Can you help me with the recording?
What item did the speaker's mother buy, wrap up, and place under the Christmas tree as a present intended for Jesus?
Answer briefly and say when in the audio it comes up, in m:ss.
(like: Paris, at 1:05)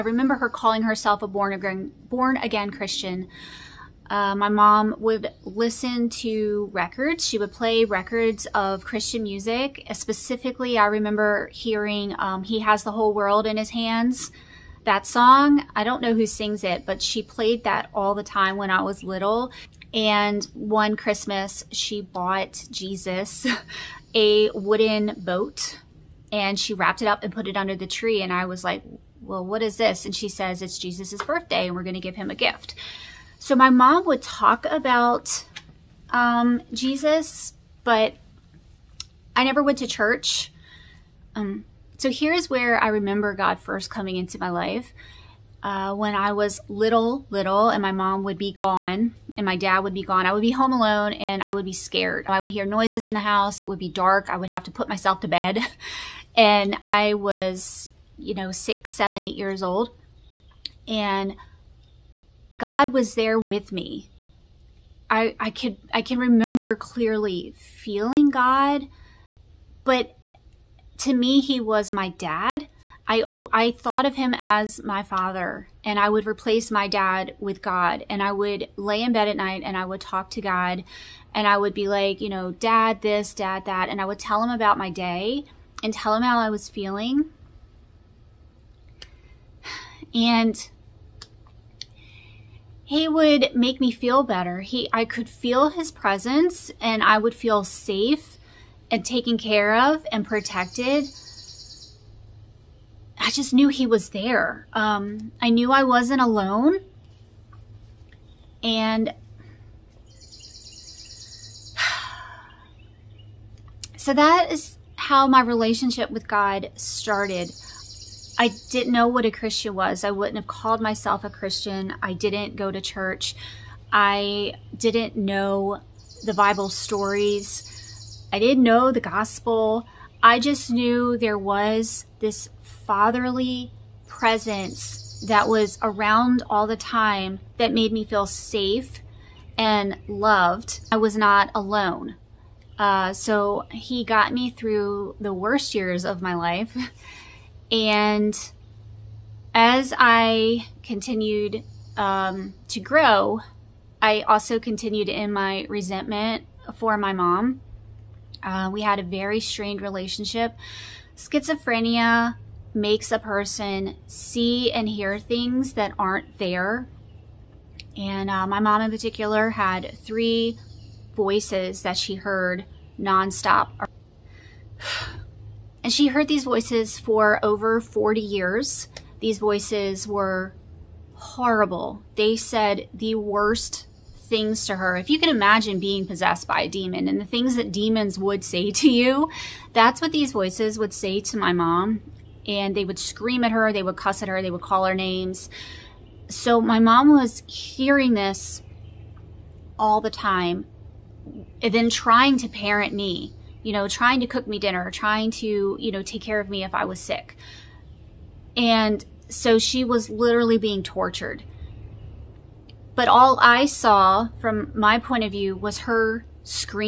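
A wooden boat, at 0:24.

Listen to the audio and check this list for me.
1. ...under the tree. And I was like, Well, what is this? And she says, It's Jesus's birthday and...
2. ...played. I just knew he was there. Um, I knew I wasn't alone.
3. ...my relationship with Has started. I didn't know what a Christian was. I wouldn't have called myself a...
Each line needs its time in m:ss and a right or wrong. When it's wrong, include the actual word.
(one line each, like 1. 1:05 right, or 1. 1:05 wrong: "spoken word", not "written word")
1. 0:27 right
2. 1:40 wrong: "protected", not "played"
3. 1:55 wrong: "God", not "Has".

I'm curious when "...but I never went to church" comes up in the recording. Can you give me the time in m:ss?
0:37.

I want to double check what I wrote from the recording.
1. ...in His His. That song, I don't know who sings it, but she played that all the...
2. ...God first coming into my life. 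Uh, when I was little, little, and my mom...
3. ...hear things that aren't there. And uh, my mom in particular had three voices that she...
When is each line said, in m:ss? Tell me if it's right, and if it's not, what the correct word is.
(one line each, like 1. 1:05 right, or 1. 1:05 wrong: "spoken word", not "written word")
1. 0:13 wrong: "Hands", not "His"
2. 0:43 right
3. 2:44 right.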